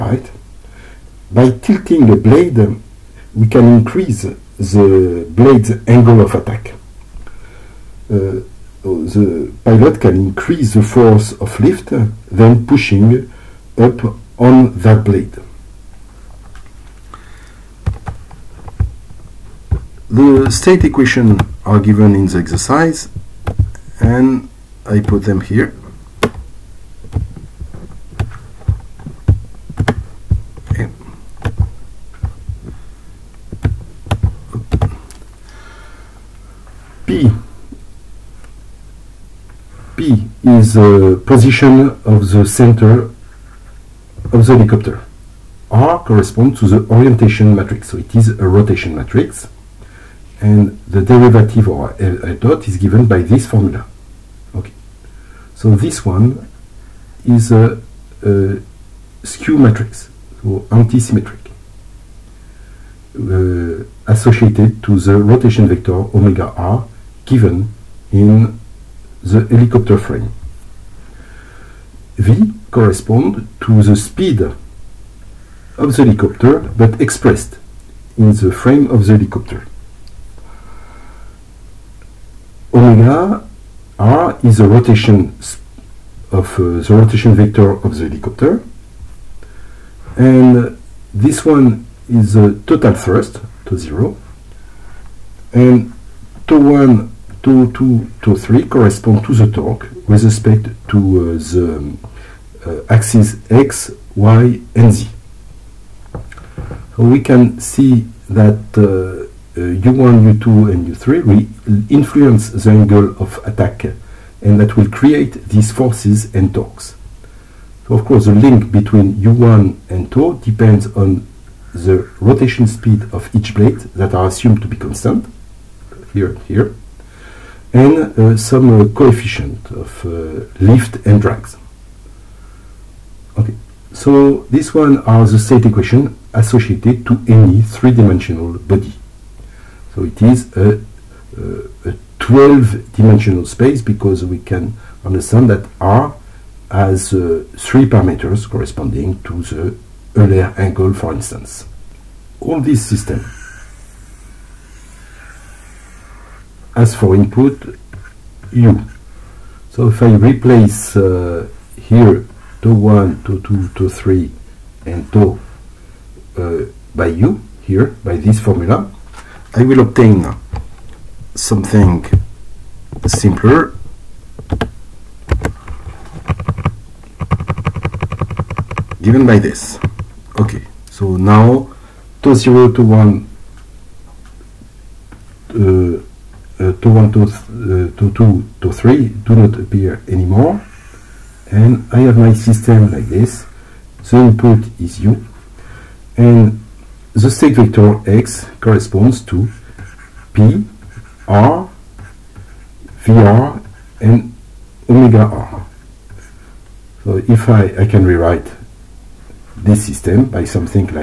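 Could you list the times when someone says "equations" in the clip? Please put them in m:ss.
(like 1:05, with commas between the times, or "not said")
0:20, 2:15.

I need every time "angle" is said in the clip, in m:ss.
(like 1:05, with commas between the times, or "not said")
0:05, 1:52, 2:30.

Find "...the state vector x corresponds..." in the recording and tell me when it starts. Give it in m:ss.
3:17.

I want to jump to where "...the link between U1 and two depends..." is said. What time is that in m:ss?
1:58.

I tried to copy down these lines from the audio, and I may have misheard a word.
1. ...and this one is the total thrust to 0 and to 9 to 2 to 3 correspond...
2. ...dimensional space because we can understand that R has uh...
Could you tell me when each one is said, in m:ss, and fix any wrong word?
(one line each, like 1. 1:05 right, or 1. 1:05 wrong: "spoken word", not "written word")
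1. 1:30 wrong: "1", not "9"
2. 2:22 right.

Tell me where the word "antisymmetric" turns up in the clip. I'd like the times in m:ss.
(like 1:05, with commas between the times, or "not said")
1:00.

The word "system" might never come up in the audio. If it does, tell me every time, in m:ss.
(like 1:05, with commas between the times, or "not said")
2:32, 3:12, 3:29.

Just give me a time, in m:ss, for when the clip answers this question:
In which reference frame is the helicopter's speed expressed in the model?
1:18.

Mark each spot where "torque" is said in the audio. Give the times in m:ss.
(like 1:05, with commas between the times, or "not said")
1:39, 1:56.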